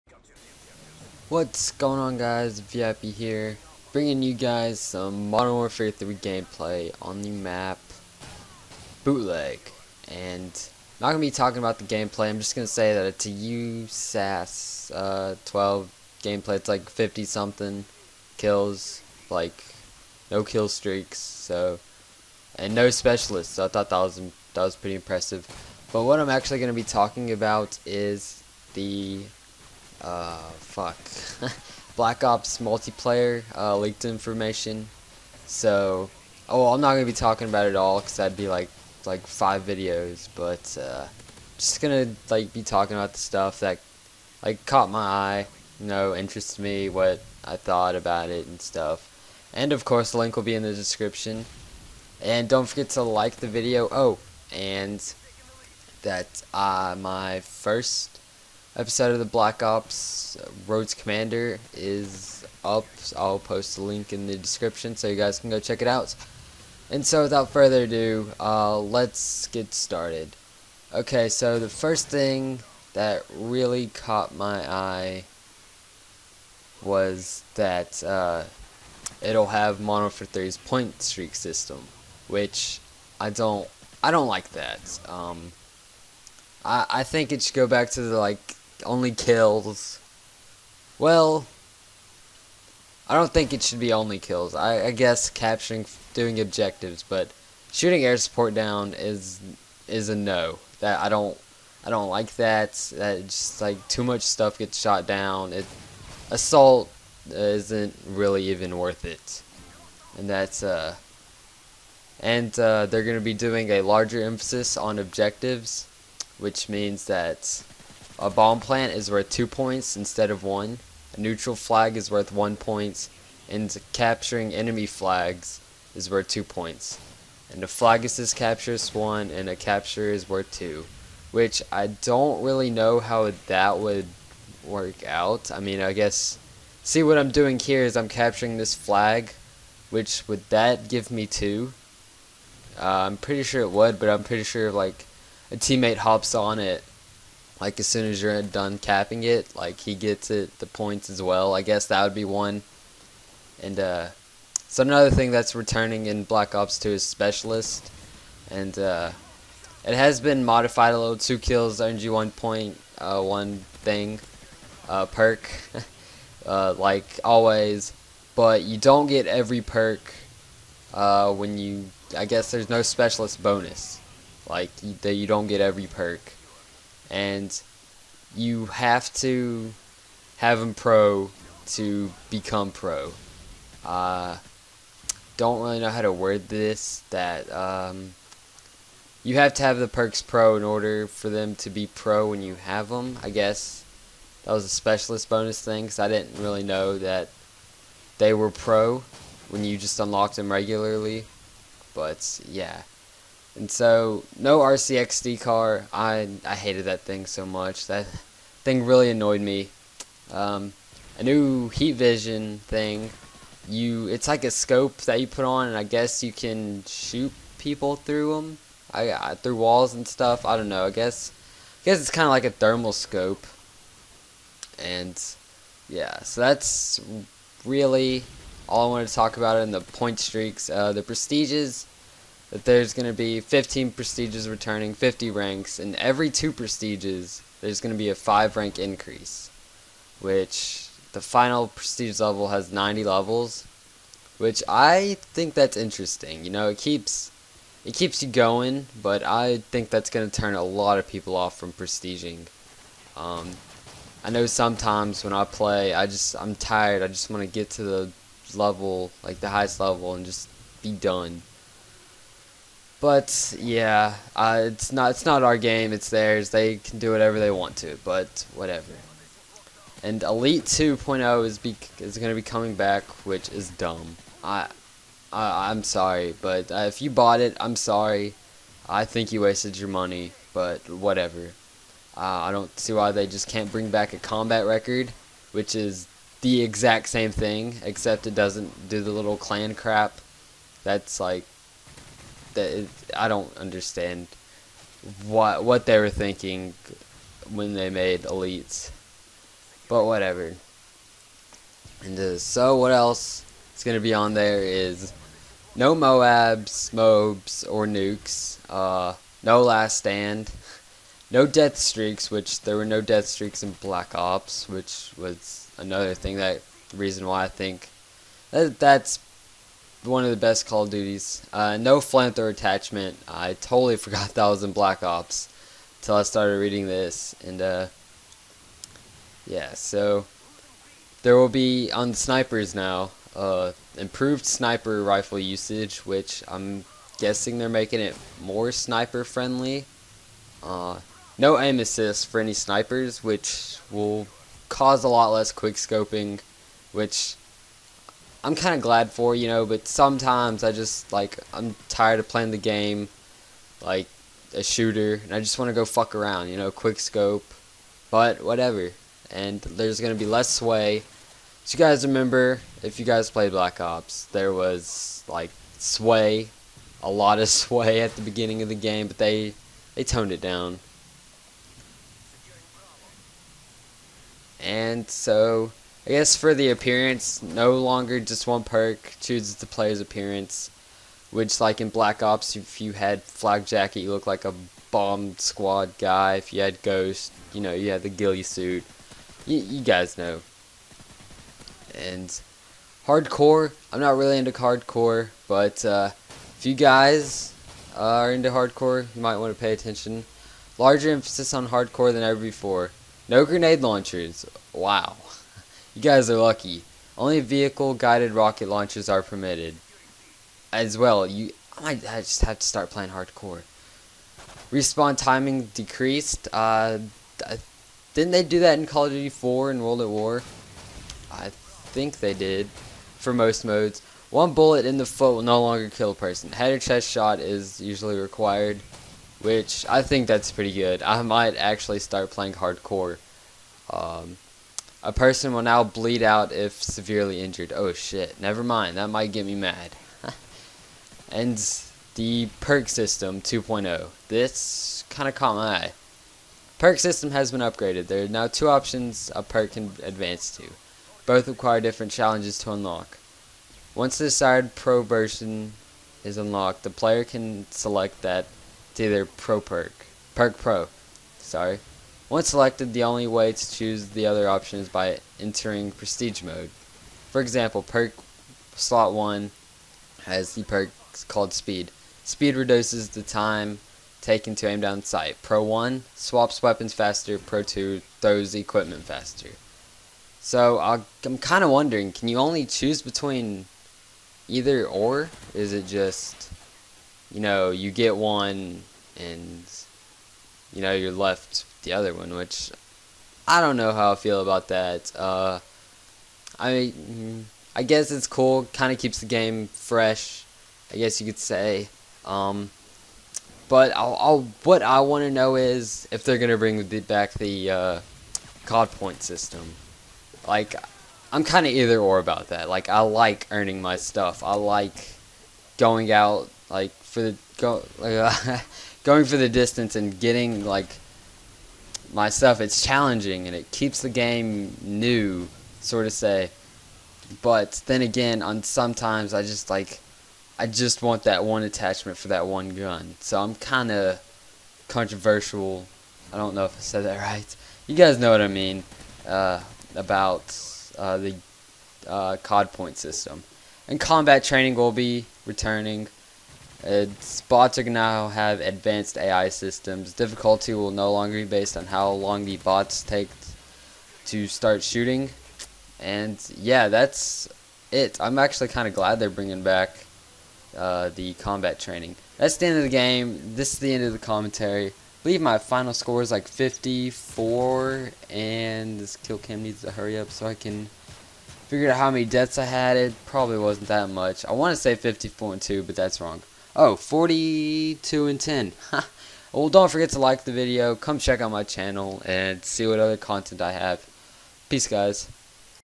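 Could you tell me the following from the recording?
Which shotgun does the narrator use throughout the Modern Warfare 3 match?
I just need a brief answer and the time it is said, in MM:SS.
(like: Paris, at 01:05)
USAS 12, at 00:13.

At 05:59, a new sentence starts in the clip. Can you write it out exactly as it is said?
And there's going to be less sway.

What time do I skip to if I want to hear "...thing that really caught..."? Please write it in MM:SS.
01:12.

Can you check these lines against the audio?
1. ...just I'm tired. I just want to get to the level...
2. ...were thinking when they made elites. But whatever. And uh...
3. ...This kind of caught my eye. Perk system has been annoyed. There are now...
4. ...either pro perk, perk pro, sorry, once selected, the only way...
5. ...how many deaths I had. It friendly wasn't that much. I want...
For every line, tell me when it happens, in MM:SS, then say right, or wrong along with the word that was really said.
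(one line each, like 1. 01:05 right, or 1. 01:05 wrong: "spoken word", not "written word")
1. 04:16 right
2. 04:55 right
3. 07:24 wrong: "upgraded", not "annoyed"
4. 07:39 right
5. 09:31 wrong: "probably", not "friendly".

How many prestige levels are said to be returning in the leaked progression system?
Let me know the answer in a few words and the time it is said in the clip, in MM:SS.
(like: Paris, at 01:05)
15, at 03:53.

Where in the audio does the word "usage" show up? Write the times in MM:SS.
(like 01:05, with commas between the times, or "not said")
05:35.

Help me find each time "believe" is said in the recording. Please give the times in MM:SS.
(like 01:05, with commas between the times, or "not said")
09:25.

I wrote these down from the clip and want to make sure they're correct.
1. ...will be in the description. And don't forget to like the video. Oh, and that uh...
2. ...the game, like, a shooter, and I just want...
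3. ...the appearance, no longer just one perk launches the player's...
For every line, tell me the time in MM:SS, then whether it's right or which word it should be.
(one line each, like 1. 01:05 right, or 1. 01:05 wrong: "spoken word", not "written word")
1. 00:50 right
2. 05:52 right
3. 06:16 wrong: "chooses", not "launches".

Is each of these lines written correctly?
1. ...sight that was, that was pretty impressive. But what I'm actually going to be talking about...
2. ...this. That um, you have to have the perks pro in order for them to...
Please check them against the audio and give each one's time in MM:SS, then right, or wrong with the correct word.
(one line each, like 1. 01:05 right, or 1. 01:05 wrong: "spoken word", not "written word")
1. 00:23 wrong: "thought", not "sight"
2. 03:06 right.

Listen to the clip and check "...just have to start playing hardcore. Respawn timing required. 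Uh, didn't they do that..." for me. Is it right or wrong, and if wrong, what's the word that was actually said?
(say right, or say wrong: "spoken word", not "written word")
wrong: "decreased", not "required".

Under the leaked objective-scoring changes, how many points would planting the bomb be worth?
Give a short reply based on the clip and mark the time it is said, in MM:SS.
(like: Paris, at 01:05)
2, at 01:59.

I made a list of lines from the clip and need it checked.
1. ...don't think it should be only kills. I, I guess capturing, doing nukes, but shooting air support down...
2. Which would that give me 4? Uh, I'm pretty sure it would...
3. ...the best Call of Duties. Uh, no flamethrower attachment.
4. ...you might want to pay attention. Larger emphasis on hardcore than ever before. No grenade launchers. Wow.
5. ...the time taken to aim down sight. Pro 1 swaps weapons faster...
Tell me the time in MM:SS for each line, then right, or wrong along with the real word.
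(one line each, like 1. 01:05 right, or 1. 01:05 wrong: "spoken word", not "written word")
1. 01:33 wrong: "objectives", not "nukes"
2. 02:19 wrong: "2", not "4"
3. 05:20 right
4. 06:39 right
5. 07:53 right.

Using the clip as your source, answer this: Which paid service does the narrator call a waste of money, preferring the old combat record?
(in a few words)
Elite 2.0.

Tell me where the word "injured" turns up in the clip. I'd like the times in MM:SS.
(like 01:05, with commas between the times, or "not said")
07:17.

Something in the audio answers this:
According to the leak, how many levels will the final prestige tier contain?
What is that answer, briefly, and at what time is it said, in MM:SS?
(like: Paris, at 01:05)
90, at 04:02.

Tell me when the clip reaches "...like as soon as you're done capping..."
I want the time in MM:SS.
02:27.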